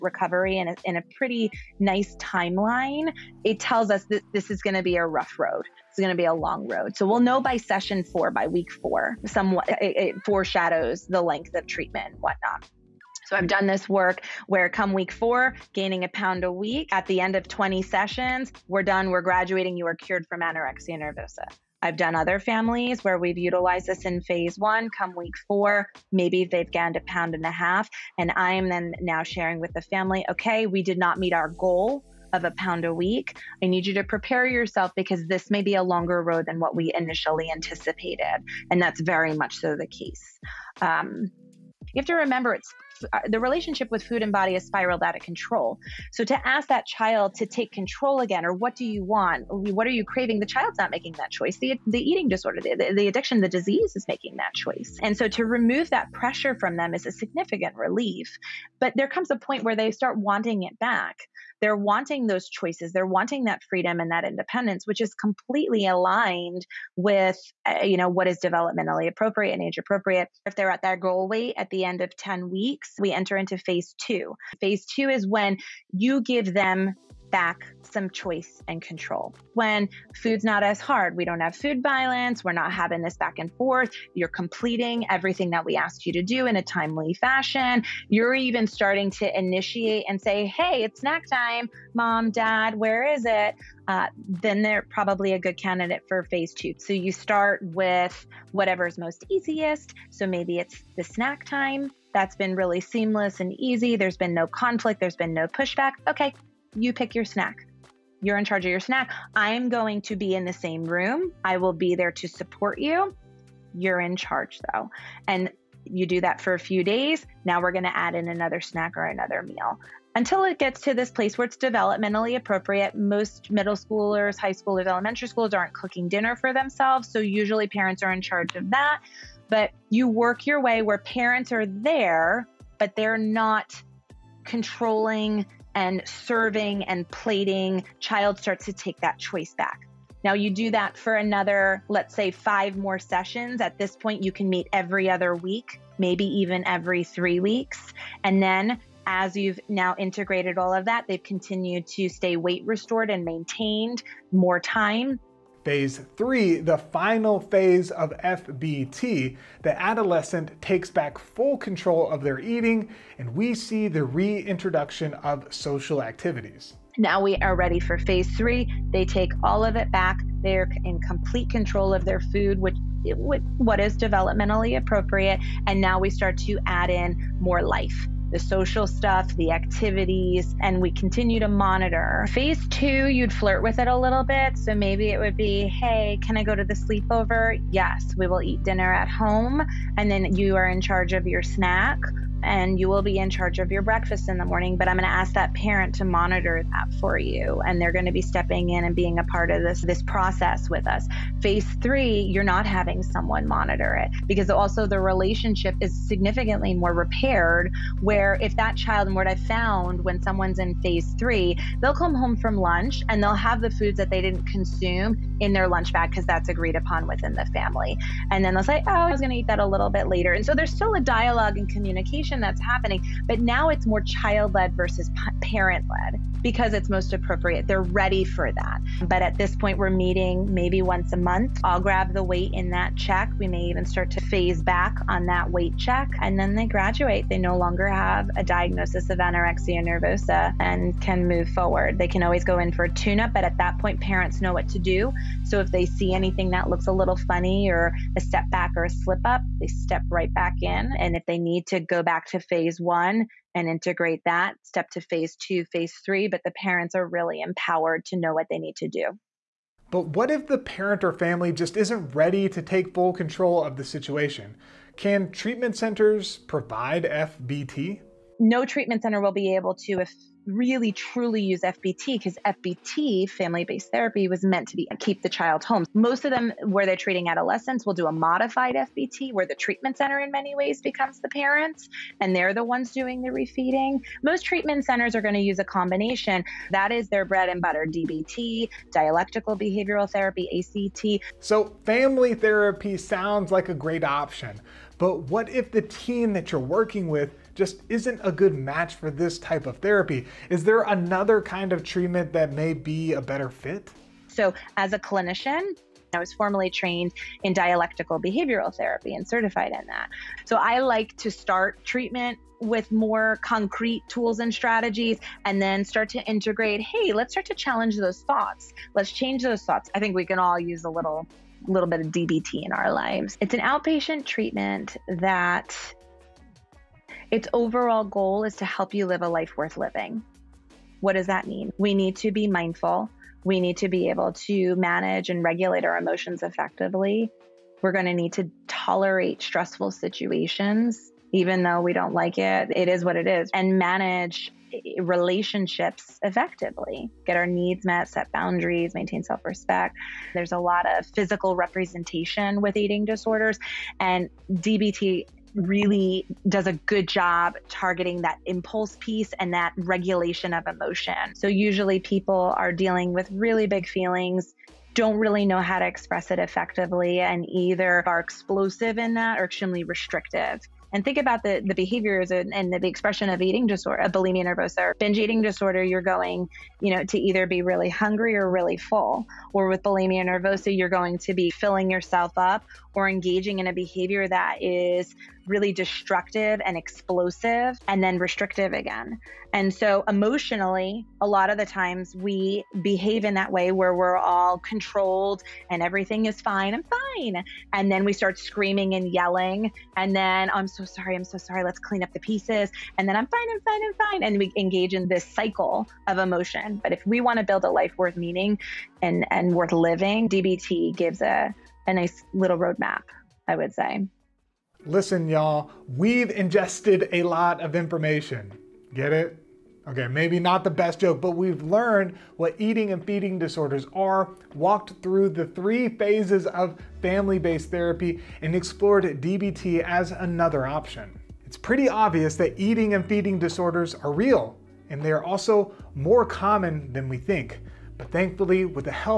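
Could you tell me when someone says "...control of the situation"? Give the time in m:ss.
4:23.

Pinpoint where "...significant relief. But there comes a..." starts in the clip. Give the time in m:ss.
0:57.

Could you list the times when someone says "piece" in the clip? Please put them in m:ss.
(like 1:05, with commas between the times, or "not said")
5:58, 6:42.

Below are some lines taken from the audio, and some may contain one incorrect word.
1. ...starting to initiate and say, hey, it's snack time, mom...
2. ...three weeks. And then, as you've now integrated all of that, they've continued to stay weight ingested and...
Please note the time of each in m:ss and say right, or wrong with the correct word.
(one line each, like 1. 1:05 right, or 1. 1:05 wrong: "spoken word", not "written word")
1. 1:28 right
2. 2:27 wrong: "restored", not "ingested".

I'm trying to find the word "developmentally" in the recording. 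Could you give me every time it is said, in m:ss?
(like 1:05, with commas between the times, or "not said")
1:08, 2:01, 2:53.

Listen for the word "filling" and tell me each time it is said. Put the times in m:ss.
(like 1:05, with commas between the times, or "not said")
6:21.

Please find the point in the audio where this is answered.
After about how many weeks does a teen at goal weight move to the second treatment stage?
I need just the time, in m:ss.
1:12.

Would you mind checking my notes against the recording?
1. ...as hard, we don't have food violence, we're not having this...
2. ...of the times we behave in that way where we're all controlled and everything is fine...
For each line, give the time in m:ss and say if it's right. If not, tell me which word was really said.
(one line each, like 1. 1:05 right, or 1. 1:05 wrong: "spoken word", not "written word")
1. 1:20 right
2. 6:31 right.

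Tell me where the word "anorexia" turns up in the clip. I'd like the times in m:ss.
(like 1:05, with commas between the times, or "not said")
0:20, 3:59.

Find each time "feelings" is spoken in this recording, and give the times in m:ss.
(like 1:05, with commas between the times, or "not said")
6:03.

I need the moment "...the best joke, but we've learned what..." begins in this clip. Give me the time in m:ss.
7:00.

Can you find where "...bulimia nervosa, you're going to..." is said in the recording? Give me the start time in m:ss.
6:19.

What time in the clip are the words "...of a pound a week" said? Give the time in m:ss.
0:32.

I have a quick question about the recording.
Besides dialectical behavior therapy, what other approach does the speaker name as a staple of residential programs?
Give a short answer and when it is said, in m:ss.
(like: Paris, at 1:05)
ACT, at 4:50.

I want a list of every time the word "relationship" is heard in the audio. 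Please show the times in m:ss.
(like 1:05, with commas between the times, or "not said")
0:43, 3:24, 5:44.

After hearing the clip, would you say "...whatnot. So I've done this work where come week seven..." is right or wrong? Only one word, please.
wrong.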